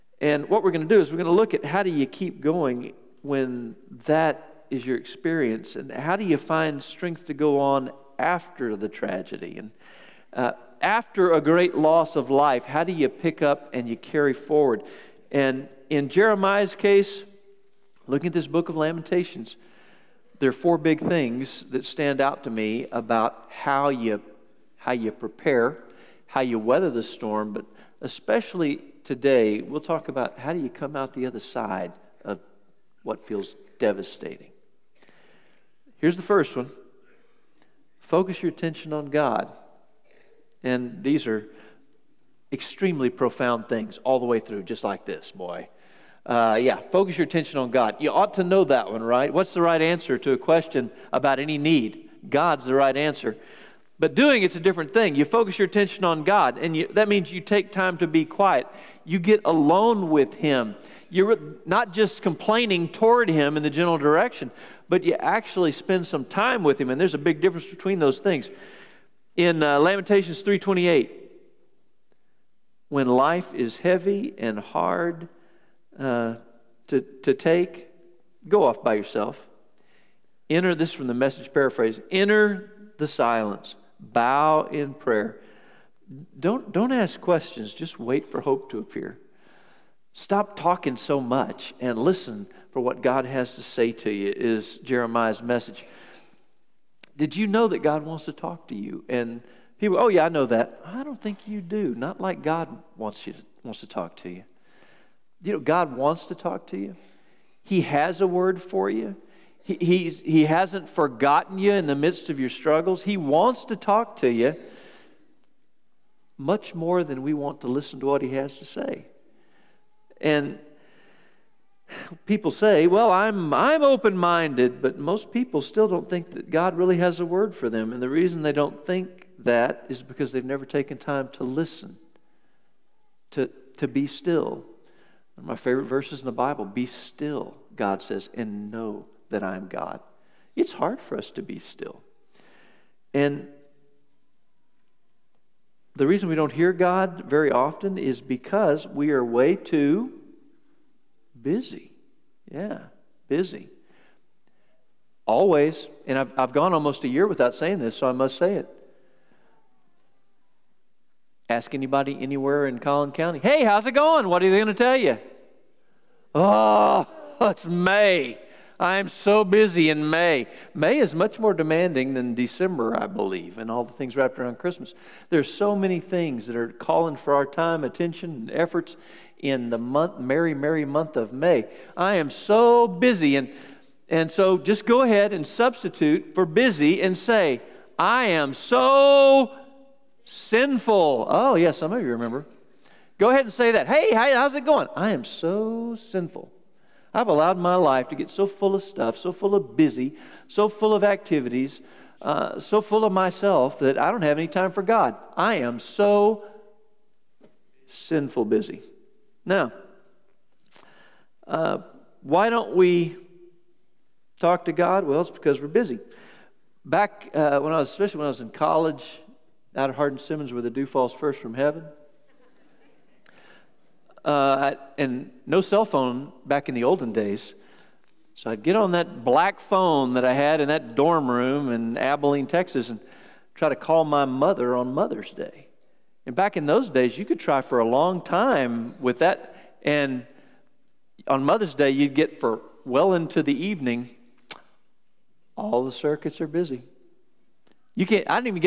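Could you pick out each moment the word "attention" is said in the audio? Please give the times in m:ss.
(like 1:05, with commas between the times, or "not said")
0:38, 0:47, 0:55, 2:57.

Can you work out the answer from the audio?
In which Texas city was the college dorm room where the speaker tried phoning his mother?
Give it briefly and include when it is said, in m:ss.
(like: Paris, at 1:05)
Abilene, at 3:51.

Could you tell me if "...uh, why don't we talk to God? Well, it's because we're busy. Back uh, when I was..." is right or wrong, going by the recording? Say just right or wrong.
right.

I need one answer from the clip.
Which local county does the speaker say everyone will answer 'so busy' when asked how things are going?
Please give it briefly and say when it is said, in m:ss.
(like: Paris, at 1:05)
Collin County, at 2:42.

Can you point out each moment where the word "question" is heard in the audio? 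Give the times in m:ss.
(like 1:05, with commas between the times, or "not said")
0:50, 1:27.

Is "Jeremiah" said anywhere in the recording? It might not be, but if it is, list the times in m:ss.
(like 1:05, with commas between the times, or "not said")
0:16, 1:34.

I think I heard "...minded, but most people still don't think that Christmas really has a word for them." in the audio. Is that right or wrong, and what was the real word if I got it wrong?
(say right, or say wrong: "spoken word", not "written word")
wrong: "God", not "Christmas".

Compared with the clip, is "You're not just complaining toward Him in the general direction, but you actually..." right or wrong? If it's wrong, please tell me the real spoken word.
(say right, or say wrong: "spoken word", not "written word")
right.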